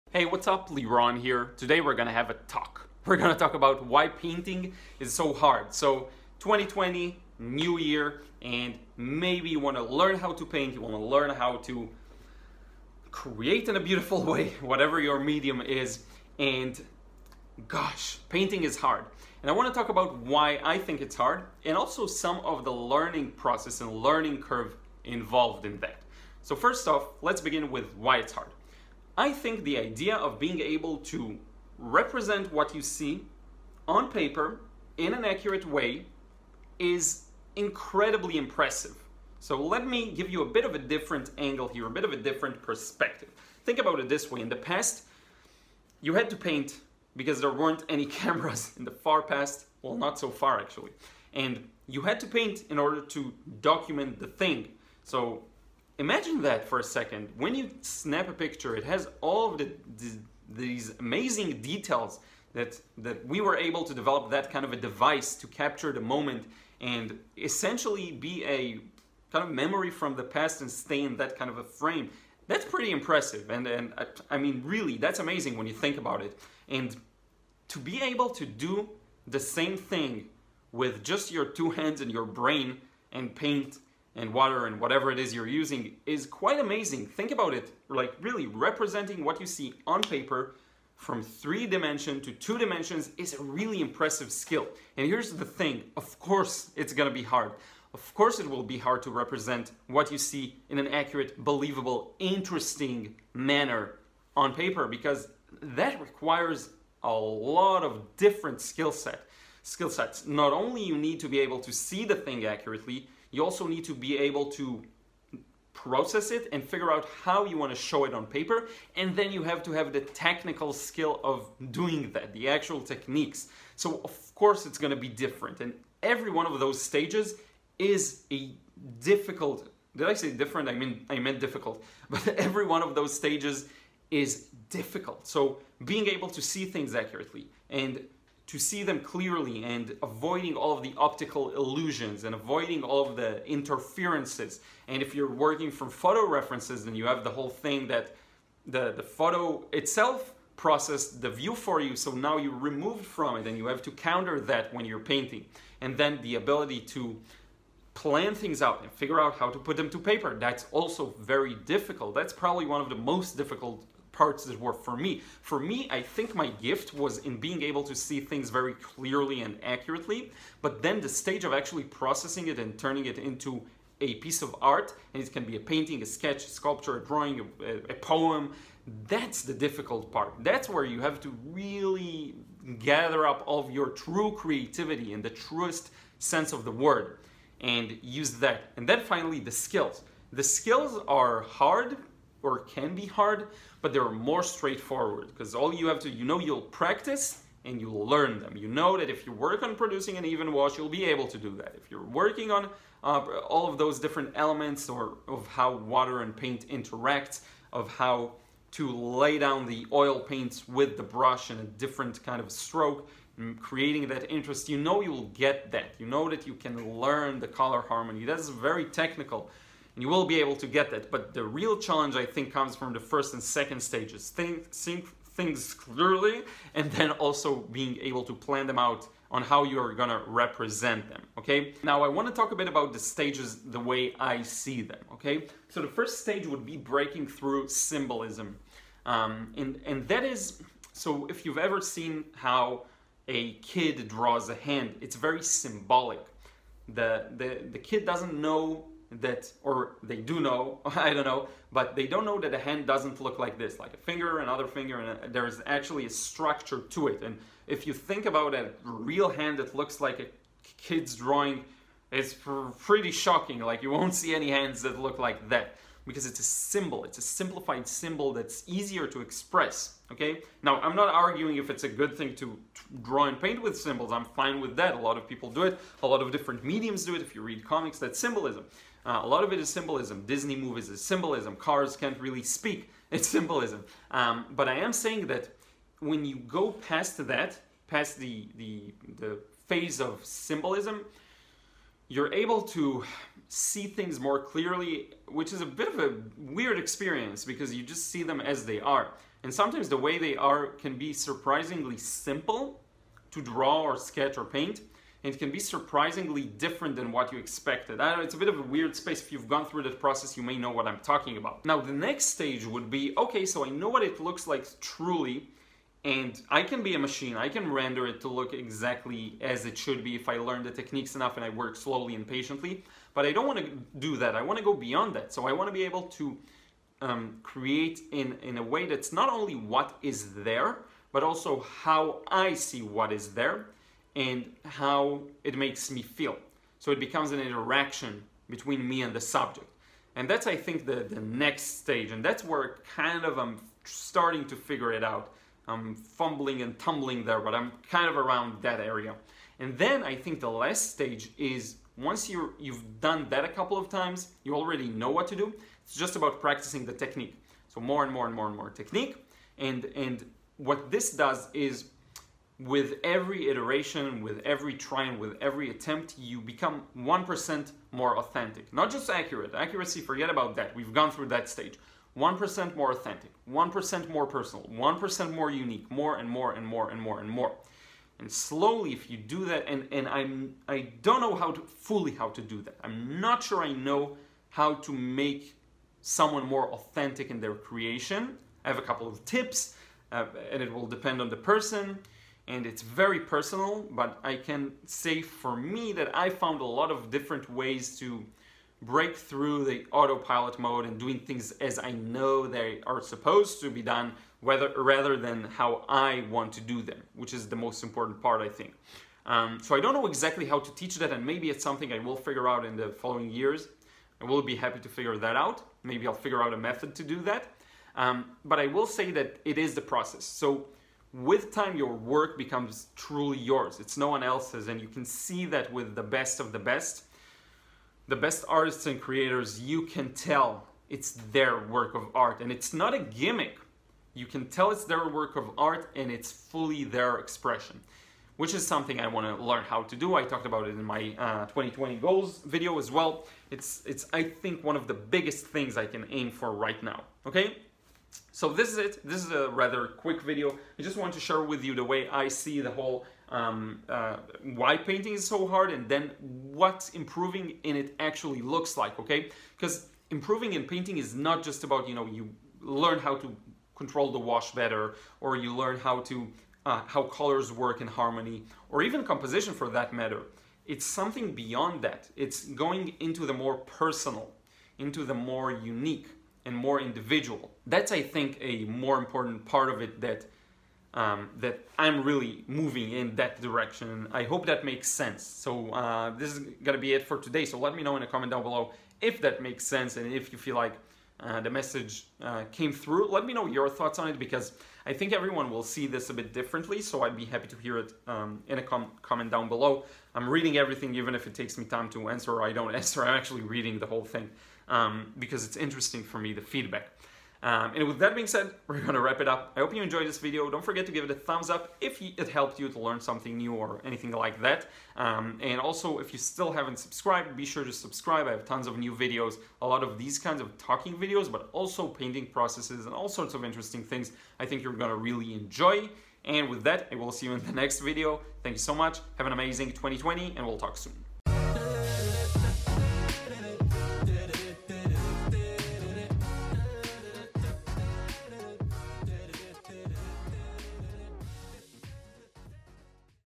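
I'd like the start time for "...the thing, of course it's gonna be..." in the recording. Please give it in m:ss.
1:35.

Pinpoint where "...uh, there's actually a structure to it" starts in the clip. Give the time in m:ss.
4:15.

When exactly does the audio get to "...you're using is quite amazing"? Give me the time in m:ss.
1:25.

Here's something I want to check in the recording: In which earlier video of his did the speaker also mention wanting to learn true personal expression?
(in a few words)
2020 goals video.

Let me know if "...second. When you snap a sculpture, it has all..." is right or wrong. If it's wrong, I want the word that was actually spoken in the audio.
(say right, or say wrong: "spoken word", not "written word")
wrong: "picture", not "sculpture".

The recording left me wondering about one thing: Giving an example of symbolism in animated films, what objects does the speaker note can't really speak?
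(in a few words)
Cars.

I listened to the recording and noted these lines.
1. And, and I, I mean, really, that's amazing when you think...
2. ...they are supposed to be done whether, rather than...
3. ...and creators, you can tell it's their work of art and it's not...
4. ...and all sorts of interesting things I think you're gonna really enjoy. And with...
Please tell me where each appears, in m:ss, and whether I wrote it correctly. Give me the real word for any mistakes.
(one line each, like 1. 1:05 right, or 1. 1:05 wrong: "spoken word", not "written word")
1. 1:13 right
2. 6:42 right
3. 7:08 right
4. 8:42 right.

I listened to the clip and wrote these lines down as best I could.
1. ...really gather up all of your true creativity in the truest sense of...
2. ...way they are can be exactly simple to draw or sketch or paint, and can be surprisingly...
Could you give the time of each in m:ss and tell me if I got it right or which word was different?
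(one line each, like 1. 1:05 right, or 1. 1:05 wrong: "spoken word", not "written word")
1. 3:01 right
2. 4:59 wrong: "surprisingly", not "exactly".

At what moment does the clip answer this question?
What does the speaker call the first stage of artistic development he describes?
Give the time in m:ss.
3:56.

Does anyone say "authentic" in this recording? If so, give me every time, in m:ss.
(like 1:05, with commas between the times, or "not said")
6:08, 6:12, 6:26.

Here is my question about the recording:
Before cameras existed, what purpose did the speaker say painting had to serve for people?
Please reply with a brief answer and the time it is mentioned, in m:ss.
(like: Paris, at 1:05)
To document, at 0:53.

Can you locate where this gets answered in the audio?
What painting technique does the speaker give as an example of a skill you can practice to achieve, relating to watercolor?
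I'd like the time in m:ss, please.
3:20.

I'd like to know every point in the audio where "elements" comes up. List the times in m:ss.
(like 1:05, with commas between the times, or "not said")
3:24.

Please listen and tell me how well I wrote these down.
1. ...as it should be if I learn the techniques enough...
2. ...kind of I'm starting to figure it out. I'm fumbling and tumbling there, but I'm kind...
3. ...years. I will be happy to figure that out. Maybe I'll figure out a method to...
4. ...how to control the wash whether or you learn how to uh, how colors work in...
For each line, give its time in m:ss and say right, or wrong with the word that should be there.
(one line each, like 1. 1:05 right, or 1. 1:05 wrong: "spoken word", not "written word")
1. 5:19 right
2. 5:42 right
3. 6:53 right
4. 7:42 wrong: "better", not "whether".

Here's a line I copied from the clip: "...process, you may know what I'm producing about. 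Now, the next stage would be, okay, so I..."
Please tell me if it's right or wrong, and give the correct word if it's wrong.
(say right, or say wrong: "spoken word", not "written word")
wrong: "talking", not "producing".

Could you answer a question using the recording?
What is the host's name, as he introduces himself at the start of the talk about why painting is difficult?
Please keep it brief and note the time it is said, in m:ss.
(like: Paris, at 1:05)
Liron, at 0:00.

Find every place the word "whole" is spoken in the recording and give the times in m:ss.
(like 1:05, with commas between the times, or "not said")
2:27, 7:32, 8:23.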